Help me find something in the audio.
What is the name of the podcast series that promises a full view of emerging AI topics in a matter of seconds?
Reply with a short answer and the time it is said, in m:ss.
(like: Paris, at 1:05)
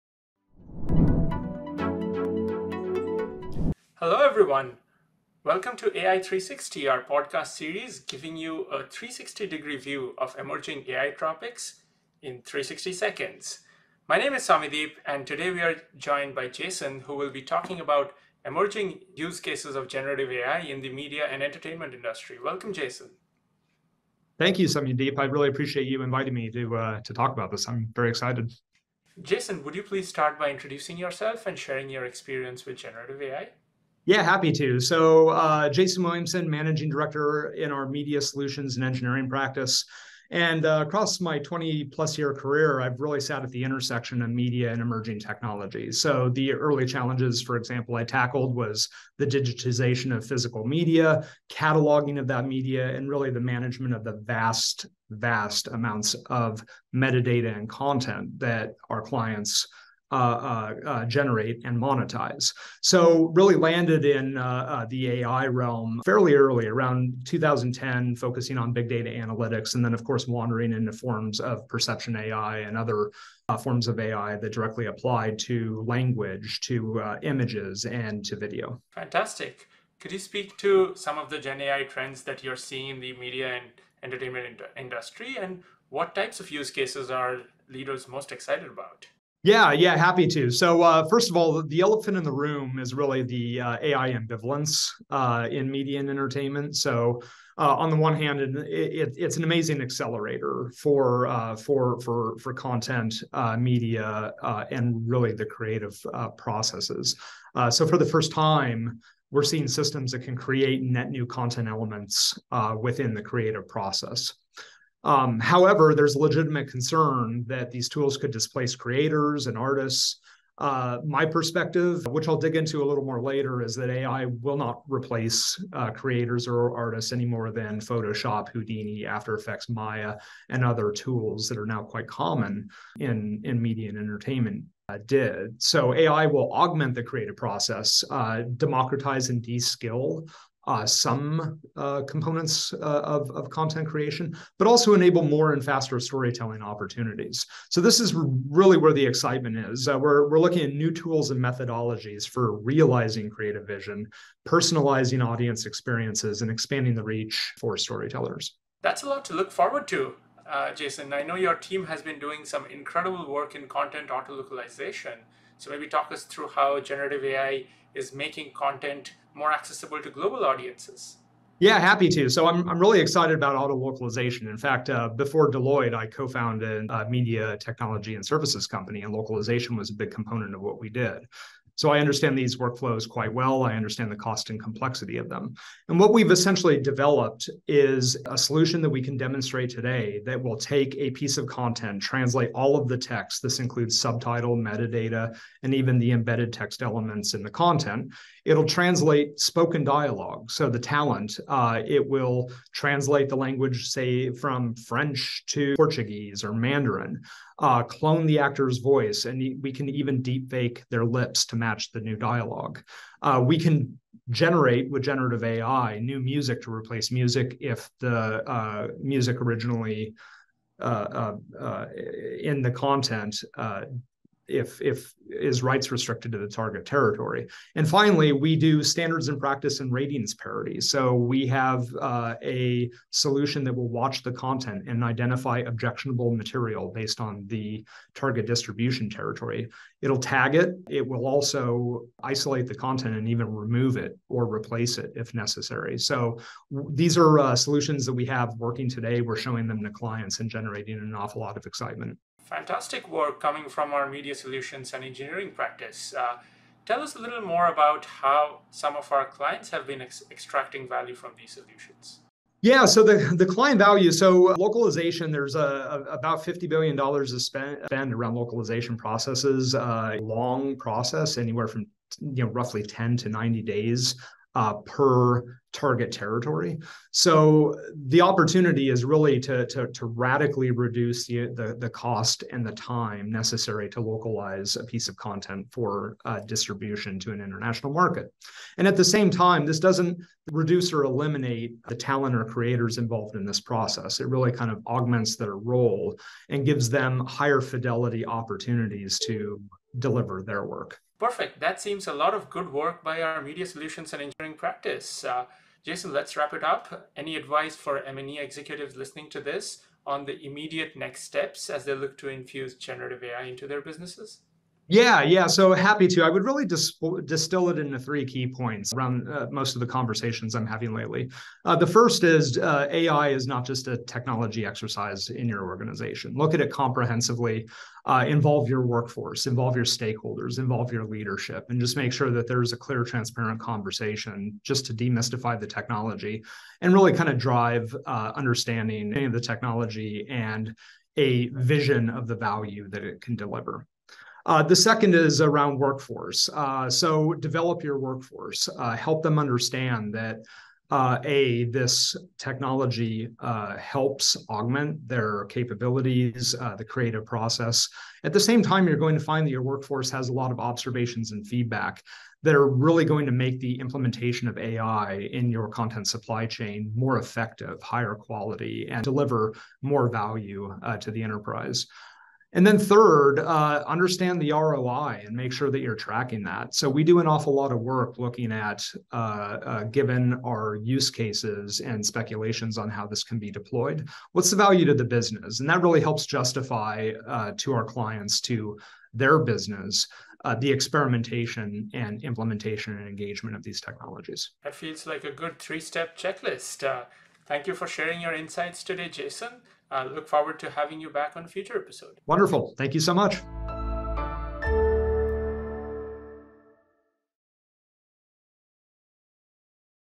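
AI360, at 0:05.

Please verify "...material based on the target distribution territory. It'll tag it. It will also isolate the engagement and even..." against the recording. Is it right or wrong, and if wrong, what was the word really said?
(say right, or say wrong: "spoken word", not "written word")
wrong: "content", not "engagement".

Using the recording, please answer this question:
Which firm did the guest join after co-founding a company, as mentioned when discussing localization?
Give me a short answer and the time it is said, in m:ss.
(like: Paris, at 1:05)
Deloitte, at 2:55.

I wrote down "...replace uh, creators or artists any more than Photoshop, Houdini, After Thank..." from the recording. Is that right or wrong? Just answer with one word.
wrong.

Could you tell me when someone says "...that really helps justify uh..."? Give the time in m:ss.
6:25.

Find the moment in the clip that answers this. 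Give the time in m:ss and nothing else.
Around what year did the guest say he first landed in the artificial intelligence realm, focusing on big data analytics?
1:07.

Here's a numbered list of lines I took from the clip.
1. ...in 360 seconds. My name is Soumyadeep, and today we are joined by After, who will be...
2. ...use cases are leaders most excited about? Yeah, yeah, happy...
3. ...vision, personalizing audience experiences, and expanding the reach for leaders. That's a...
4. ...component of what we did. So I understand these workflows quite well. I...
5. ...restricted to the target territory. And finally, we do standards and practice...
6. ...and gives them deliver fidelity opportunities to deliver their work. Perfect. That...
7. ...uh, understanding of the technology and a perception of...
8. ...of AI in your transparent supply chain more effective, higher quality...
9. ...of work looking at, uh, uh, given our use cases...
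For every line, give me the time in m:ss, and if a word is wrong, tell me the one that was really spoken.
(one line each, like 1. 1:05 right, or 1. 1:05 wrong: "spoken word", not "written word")
1. 0:12 wrong: "Jason", not "After"
2. 1:26 right
3. 2:33 wrong: "storytellers", not "leaders"
4. 3:00 right
5. 3:45 right
6. 4:56 wrong: "higher", not "deliver"
7. 5:38 wrong: "vision", not "perception"
8. 6:04 wrong: "content", not "transparent"
9. 6:17 right.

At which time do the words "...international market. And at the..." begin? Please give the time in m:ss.
4:47.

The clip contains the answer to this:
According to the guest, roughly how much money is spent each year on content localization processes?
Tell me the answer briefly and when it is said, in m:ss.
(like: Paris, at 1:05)
$50 billion, at 4:26.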